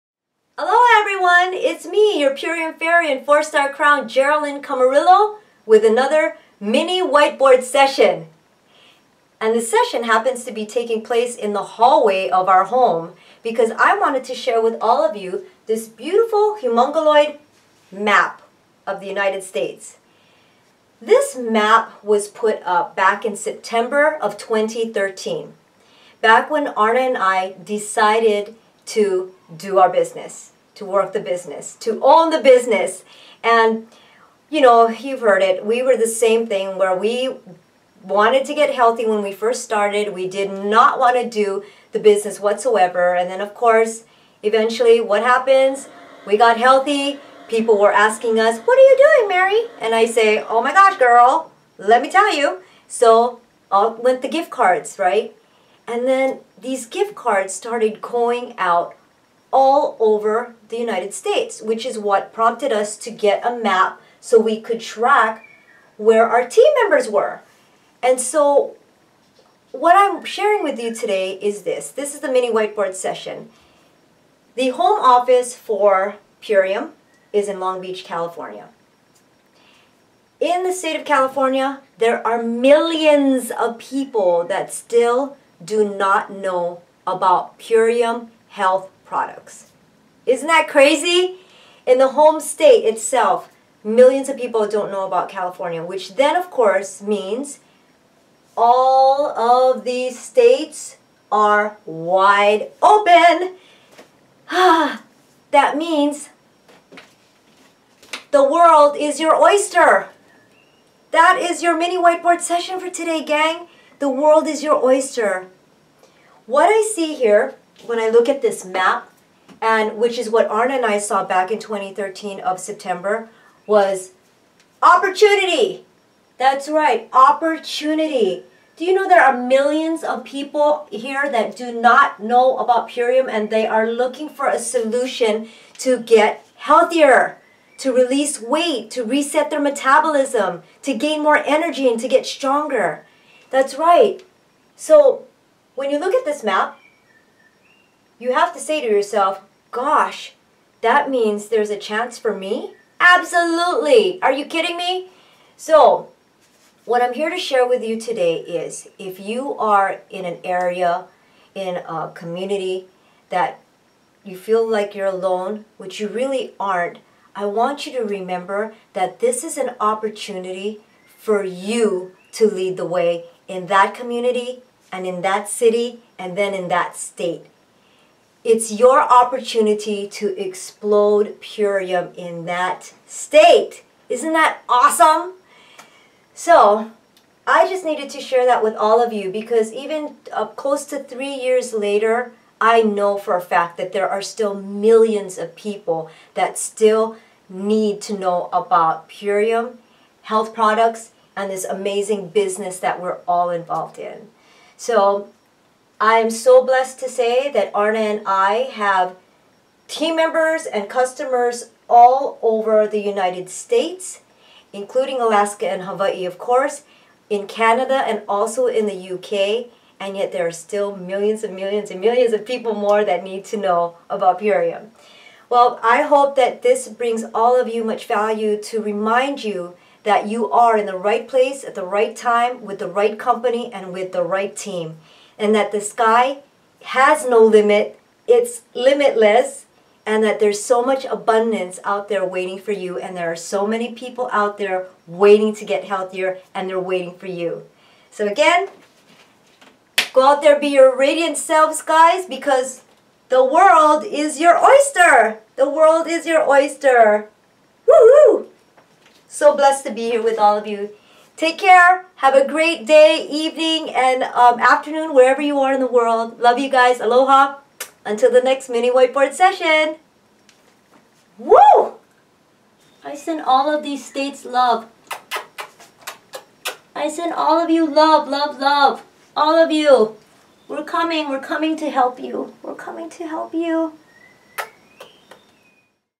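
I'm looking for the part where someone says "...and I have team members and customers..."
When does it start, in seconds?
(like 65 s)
207 s.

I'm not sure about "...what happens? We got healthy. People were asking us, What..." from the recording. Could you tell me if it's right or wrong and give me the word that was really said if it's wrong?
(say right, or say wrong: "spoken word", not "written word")
right.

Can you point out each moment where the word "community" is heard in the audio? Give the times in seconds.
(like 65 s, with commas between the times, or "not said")
162 s, 173 s.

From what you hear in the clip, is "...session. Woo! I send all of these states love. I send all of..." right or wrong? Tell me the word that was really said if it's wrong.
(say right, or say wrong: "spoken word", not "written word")
right.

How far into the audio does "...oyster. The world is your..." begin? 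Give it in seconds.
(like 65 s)
254 s.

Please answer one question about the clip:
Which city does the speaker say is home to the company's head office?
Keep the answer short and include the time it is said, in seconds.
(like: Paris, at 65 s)
Long Beach, at 77 s.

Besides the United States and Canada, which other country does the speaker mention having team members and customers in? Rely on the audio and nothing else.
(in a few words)
UK.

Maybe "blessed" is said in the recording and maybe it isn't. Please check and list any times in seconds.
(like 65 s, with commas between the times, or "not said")
206 s, 259 s.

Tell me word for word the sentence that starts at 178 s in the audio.
It's your opportunity to explode purium in that state.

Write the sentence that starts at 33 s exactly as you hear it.
And, you know, you've heard it.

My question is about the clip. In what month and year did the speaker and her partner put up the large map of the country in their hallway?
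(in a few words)
September 2013.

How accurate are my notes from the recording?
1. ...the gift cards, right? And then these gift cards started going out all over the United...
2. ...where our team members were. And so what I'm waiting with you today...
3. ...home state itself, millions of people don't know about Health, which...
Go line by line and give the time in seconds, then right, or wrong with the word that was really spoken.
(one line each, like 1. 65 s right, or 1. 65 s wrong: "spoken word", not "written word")
1. 54 s right
2. 65 s wrong: "sharing", not "waiting"
3. 92 s wrong: "California", not "Health".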